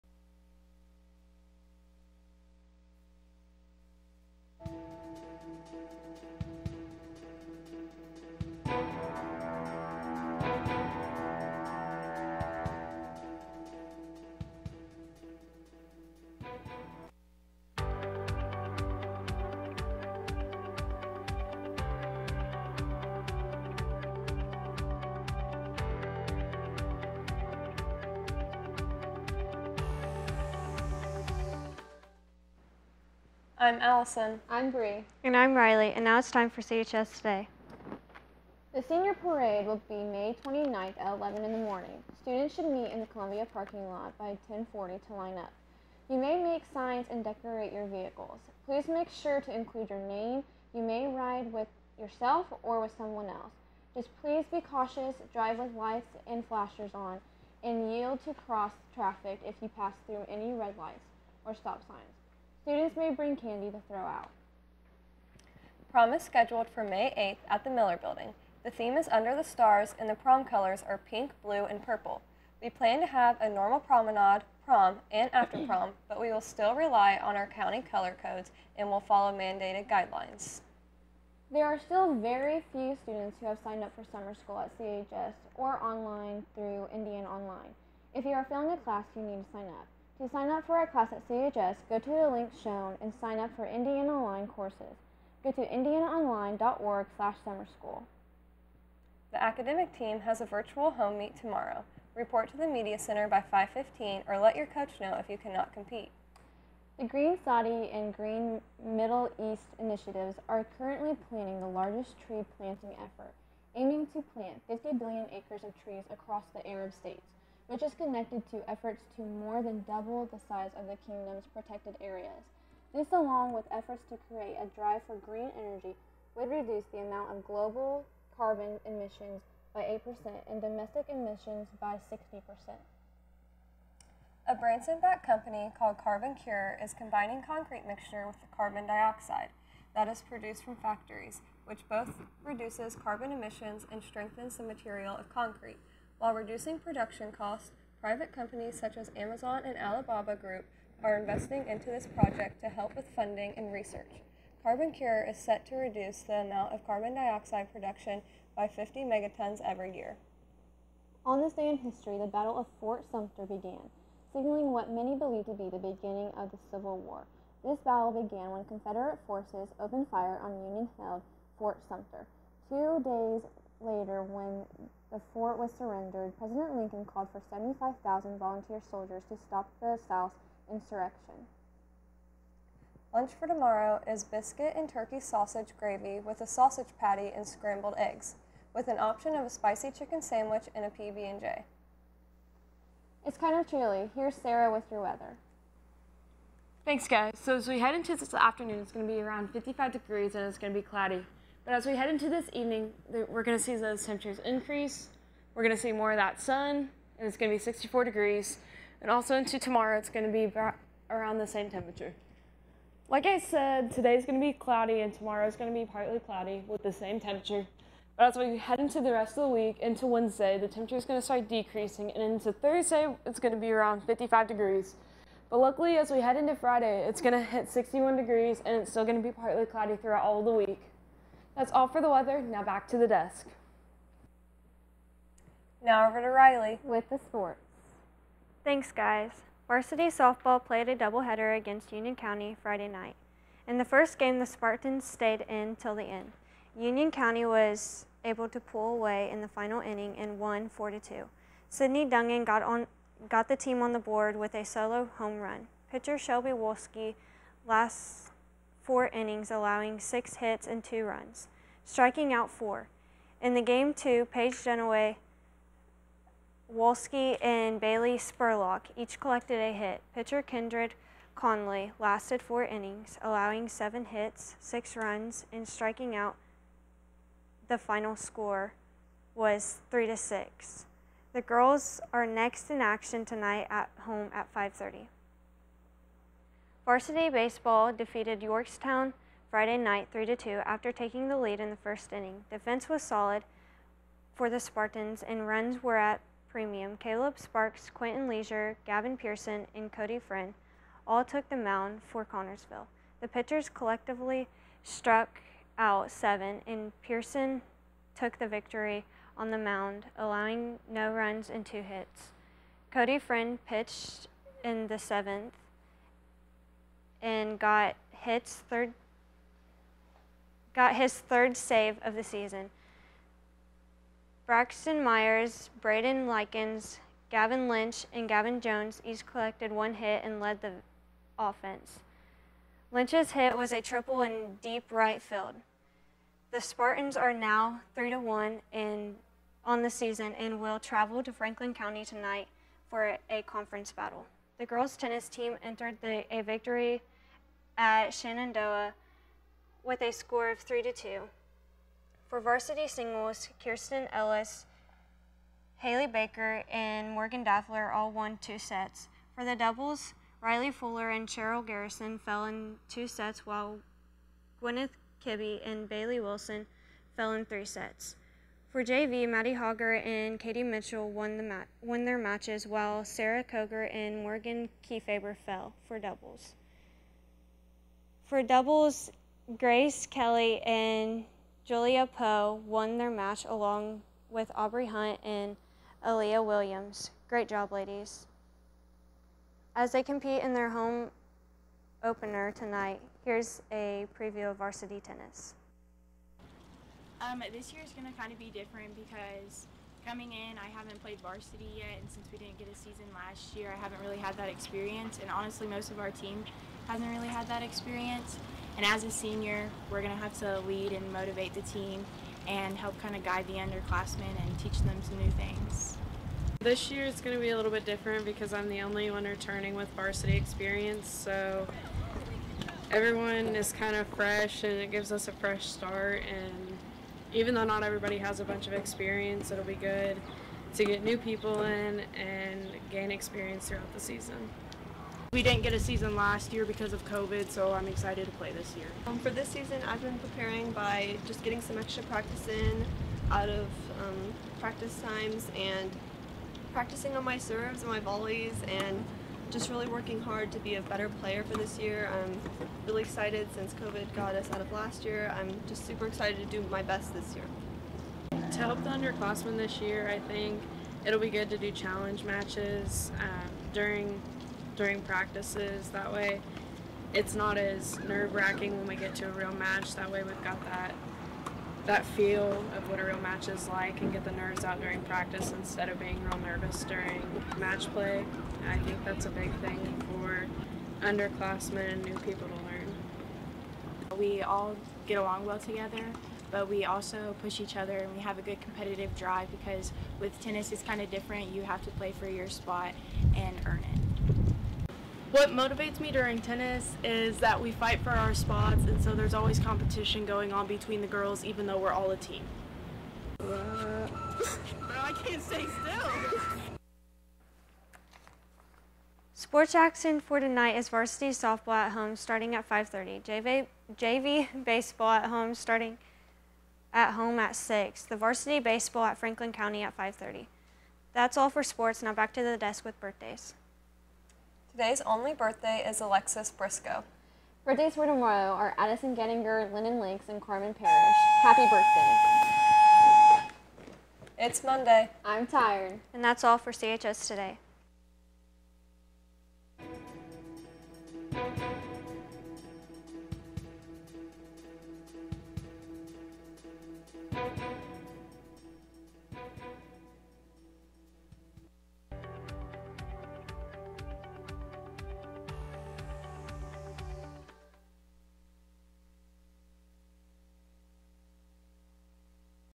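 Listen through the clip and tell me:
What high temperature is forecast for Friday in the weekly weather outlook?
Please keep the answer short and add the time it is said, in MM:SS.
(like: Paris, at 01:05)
61 degrees, at 03:47.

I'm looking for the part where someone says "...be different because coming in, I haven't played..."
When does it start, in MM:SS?
06:38.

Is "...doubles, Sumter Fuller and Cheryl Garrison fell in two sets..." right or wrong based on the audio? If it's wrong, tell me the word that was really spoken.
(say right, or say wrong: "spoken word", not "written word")
wrong: "Riley", not "Sumter".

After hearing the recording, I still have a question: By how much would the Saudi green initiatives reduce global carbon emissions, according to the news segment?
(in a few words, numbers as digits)
8%.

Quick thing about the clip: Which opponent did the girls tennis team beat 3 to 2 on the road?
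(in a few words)
Shenandoah.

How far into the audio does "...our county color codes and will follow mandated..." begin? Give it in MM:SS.
01:17.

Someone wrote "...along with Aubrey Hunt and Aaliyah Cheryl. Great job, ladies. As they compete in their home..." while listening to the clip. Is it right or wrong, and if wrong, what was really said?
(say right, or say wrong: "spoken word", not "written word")
wrong: "Williams", not "Cheryl".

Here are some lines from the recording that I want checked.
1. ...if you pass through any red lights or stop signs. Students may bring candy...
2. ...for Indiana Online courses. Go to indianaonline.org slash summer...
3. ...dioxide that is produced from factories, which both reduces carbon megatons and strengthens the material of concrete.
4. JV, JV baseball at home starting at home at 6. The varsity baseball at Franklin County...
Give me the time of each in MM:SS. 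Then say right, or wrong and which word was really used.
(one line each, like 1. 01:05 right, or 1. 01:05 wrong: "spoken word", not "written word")
1. 00:59 right
2. 01:33 right
3. 02:18 wrong: "emissions", not "megatons"
4. 08:33 right.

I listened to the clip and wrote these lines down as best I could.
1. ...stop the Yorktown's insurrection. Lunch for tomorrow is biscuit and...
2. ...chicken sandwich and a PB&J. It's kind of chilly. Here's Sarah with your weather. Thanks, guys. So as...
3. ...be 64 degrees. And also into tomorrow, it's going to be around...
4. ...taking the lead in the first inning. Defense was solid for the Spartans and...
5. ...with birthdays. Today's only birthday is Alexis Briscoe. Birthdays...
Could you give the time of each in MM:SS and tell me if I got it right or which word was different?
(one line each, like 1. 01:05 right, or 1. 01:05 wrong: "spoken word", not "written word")
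1. 02:59 wrong: "South", not "Yorktown"
2. 03:09 right
3. 03:27 right
4. 04:50 right
5. 08:42 right.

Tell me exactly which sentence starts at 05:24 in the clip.
Braxton Myers, Braden Likens, Gavin Lynch, and Gavin Jones each collected one hit and led the offense.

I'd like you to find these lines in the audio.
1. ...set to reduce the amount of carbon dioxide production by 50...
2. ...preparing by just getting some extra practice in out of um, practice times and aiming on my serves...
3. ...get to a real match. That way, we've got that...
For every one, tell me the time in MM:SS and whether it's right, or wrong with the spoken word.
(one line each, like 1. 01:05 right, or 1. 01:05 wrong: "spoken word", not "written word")
1. 02:35 right
2. 07:20 wrong: "practicing", not "aiming"
3. 07:48 right.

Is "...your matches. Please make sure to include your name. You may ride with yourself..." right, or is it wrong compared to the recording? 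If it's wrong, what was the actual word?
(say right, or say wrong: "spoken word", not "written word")
wrong: "vehicles", not "matches".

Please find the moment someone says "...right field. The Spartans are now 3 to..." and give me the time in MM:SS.
05:34.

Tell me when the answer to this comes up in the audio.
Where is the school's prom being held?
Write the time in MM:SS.
01:07.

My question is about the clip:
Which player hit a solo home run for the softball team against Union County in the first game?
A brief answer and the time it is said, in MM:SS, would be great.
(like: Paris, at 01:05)
Sydney Dungan, at 04:11.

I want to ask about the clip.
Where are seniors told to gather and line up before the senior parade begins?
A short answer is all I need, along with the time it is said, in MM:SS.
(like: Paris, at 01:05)
Columbia parking lot, at 00:43.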